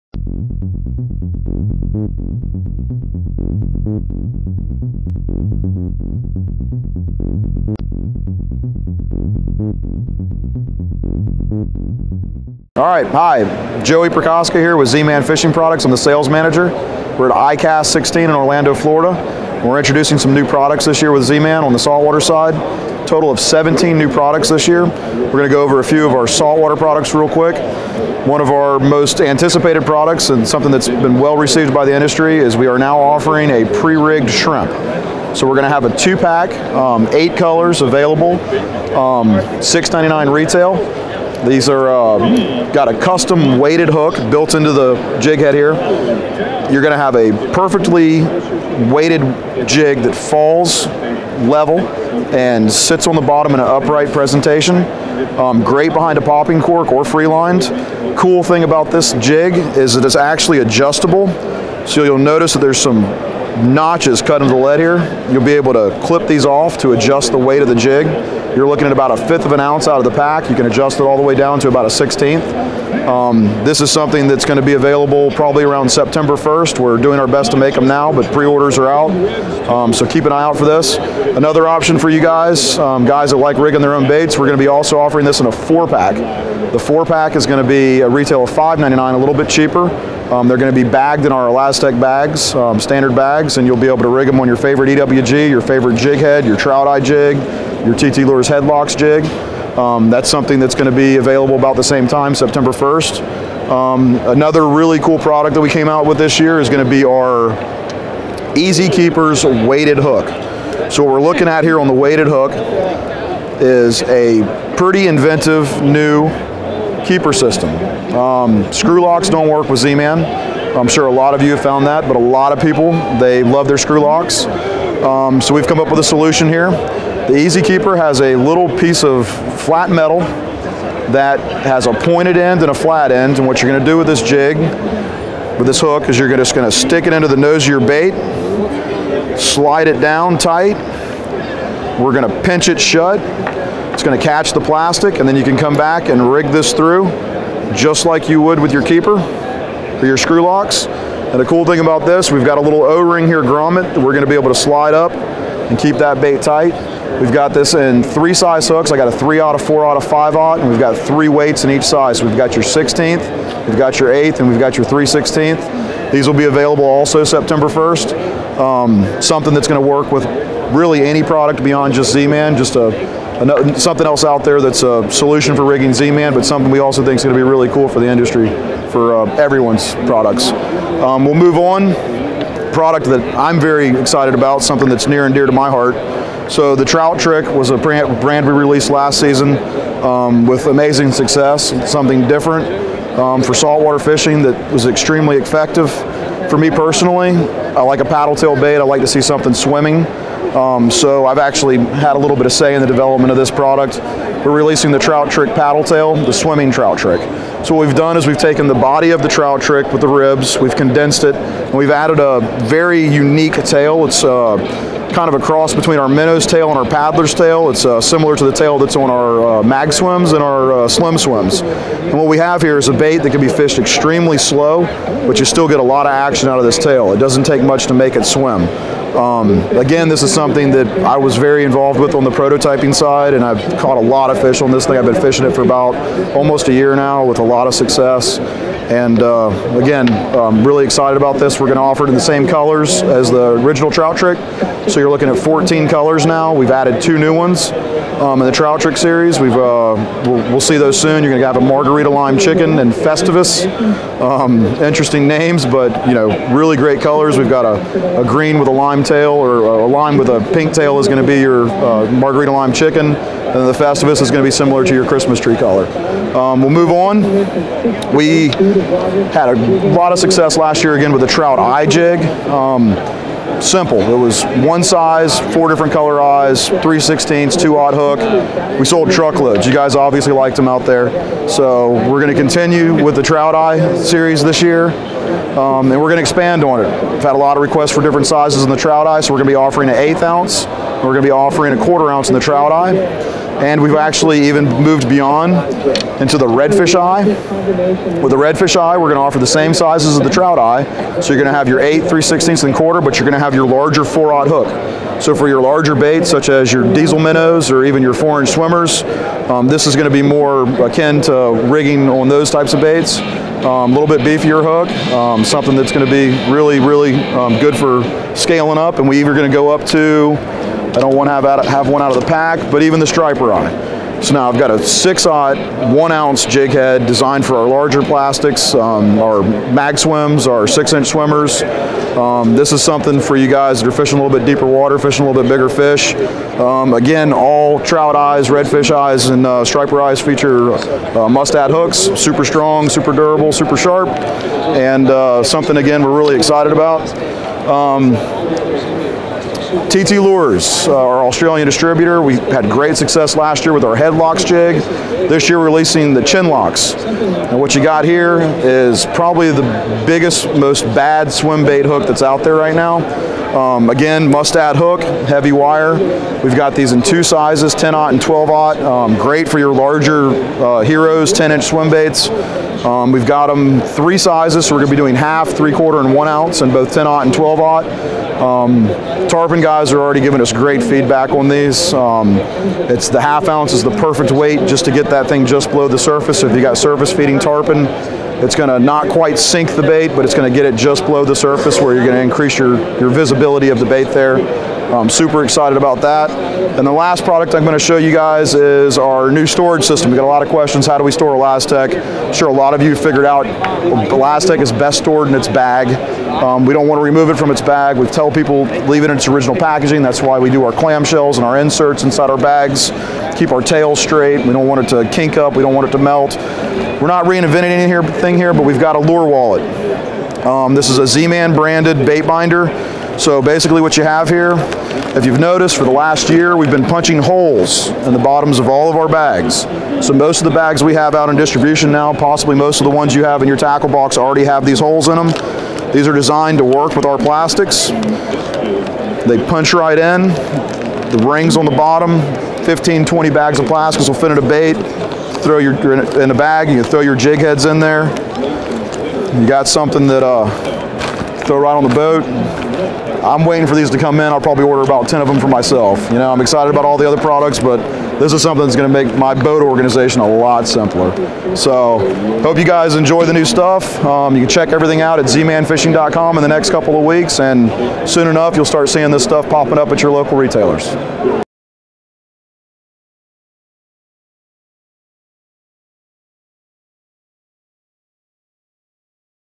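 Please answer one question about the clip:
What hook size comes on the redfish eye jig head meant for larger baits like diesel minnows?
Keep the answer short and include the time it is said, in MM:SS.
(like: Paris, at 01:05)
4/0, at 05:04.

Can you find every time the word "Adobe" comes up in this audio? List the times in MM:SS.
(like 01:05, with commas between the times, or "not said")
not said.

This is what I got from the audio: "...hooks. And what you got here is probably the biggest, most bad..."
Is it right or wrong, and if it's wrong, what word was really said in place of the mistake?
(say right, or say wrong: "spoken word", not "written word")
wrong: "locks", not "hooks".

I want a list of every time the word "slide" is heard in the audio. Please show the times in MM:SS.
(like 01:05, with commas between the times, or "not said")
02:19, 02:34.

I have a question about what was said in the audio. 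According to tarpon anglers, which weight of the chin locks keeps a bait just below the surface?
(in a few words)
Half ounce.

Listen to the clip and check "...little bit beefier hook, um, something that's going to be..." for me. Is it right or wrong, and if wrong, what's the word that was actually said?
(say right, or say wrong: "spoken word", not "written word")
right.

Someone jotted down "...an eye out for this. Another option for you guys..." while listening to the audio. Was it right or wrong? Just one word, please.
right.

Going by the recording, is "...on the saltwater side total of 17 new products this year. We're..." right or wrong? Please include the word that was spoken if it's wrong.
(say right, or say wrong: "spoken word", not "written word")
right.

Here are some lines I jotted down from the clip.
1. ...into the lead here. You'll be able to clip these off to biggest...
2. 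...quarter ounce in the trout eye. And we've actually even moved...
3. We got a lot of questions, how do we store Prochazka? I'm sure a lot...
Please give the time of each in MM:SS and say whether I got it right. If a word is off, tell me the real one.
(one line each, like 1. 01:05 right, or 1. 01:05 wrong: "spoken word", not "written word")
1. 01:04 wrong: "adjust", not "biggest"
2. 04:51 right
3. 06:40 wrong: "ElaZtech", not "Prochazka".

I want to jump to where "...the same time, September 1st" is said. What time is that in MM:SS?
01:41.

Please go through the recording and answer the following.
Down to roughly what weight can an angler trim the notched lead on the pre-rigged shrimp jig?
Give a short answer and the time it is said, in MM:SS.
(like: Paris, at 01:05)
1/16 ounce, at 01:11.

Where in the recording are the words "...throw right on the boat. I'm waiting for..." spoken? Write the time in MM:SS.
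07:31.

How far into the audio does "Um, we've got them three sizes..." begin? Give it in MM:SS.
06:12.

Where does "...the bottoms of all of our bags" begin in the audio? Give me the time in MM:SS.
07:08.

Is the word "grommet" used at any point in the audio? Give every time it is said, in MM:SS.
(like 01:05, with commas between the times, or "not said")
02:33.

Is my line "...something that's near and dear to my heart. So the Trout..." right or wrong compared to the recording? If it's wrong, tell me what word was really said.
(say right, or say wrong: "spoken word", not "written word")
right.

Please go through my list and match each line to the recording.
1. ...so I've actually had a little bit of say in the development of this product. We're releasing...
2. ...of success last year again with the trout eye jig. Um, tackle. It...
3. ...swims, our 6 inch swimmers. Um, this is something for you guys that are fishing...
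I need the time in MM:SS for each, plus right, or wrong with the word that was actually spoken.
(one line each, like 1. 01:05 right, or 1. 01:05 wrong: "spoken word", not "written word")
1. 03:20 right
2. 04:30 wrong: "simple", not "tackle"
3. 05:29 right.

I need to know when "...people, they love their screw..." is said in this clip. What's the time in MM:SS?
02:02.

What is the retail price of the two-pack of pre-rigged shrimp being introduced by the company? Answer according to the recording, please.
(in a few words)
$6.99.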